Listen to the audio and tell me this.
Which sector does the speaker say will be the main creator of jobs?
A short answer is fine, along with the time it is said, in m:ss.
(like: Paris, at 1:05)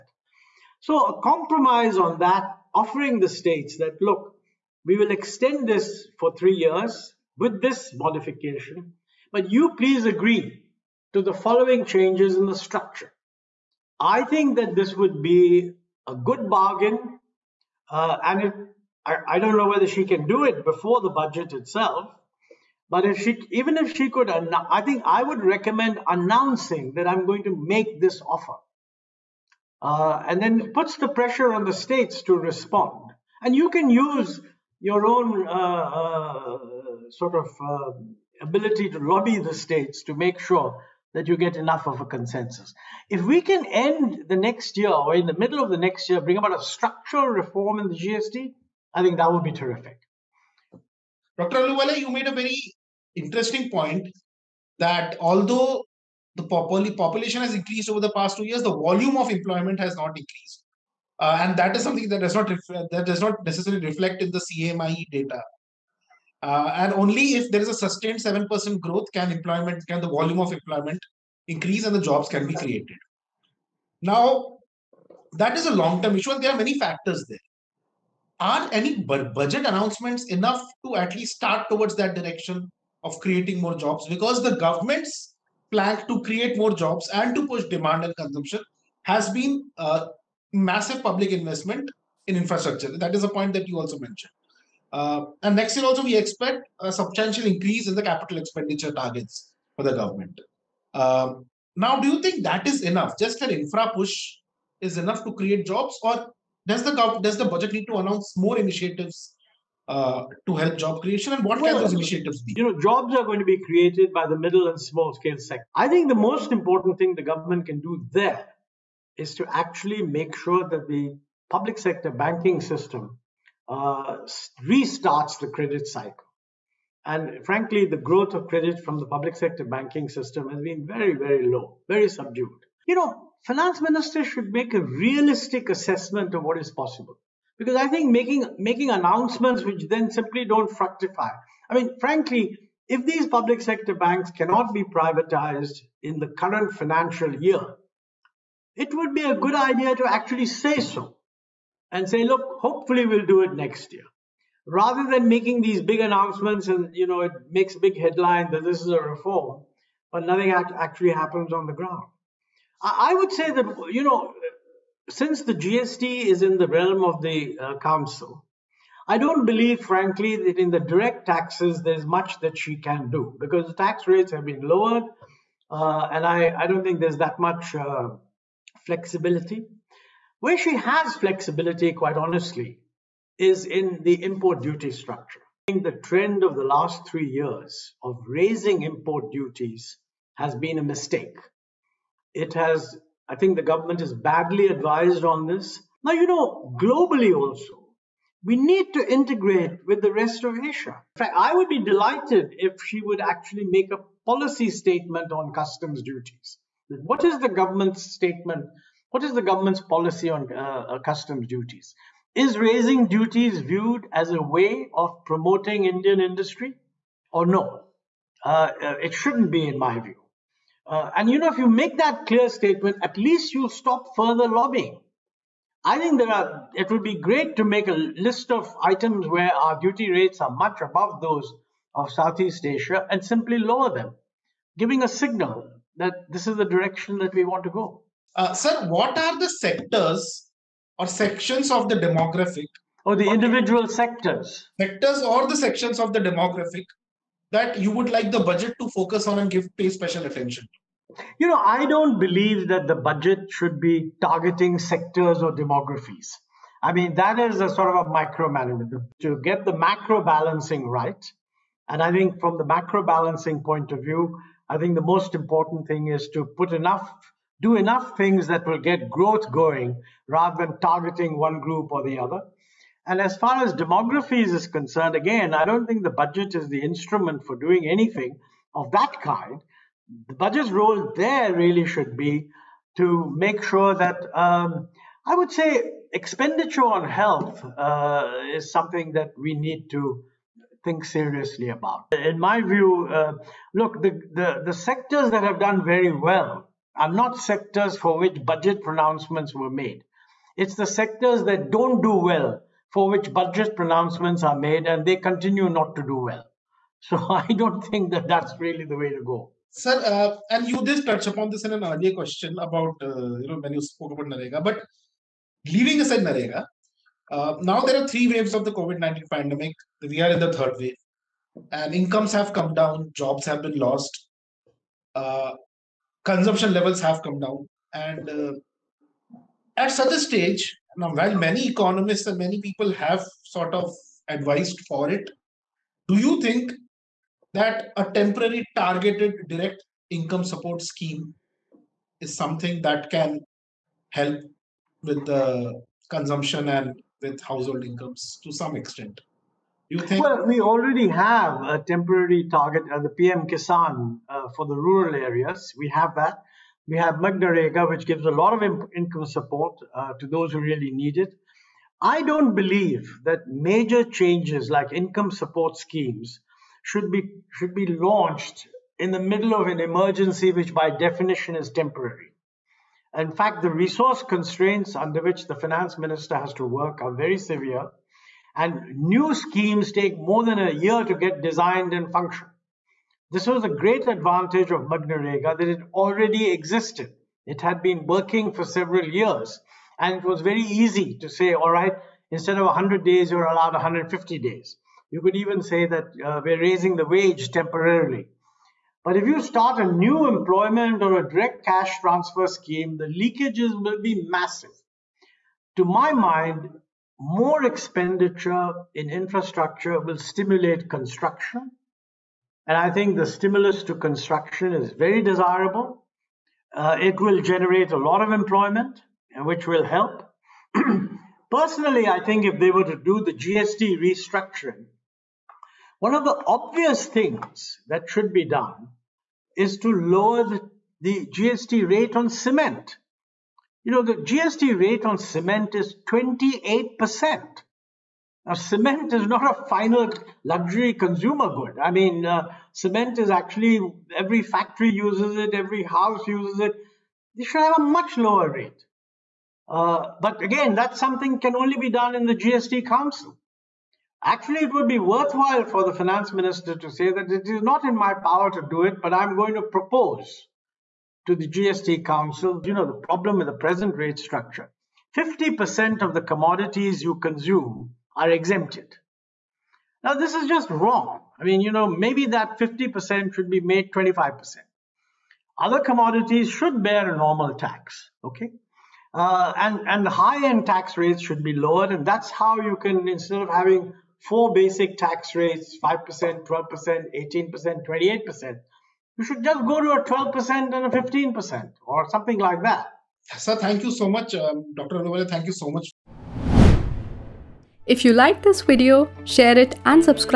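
Middle and small scale sector, at 1:54.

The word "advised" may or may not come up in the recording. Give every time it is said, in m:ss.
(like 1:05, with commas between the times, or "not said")
3:14, 5:34.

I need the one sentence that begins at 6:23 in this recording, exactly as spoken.
This was a great advantage of MGNREGA that it already existed.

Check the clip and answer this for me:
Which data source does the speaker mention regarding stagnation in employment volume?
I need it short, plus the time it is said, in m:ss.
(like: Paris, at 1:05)
CMIE, at 1:04.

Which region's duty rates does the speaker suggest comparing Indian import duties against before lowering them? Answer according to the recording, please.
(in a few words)
Southeast Asia.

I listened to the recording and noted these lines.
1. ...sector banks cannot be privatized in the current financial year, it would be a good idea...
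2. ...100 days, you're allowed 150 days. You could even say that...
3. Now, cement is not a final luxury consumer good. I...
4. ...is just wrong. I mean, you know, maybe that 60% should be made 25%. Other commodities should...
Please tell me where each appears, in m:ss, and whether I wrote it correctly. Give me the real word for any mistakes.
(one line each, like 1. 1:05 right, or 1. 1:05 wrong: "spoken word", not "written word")
1. 2:23 right
2. 6:32 right
3. 7:18 right
4. 7:50 wrong: "50", not "60".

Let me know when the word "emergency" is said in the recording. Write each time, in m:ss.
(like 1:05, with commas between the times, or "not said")
6:09.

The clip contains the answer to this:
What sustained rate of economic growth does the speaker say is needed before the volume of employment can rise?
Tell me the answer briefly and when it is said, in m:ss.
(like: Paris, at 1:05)
7%, at 1:08.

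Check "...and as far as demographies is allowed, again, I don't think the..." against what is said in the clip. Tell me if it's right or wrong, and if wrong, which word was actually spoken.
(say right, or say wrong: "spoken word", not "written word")
wrong: "concerned", not "allowed".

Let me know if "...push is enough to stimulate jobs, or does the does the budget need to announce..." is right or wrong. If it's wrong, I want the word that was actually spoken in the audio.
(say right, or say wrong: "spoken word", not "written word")
wrong: "create", not "stimulate".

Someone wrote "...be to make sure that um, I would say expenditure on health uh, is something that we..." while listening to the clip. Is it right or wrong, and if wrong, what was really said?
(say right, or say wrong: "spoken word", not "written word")
right.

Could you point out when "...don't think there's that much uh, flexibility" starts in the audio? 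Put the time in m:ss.
2:56.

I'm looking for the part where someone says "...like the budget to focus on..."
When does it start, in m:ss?
4:08.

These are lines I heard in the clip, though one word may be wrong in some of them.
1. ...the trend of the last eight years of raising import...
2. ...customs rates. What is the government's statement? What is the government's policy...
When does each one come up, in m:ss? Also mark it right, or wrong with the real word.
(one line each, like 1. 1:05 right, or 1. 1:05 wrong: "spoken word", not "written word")
1. 3:05 wrong: "three", not "eight"
2. 3:25 wrong: "duties", not "rates".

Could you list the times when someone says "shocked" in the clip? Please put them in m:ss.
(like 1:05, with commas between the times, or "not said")
not said.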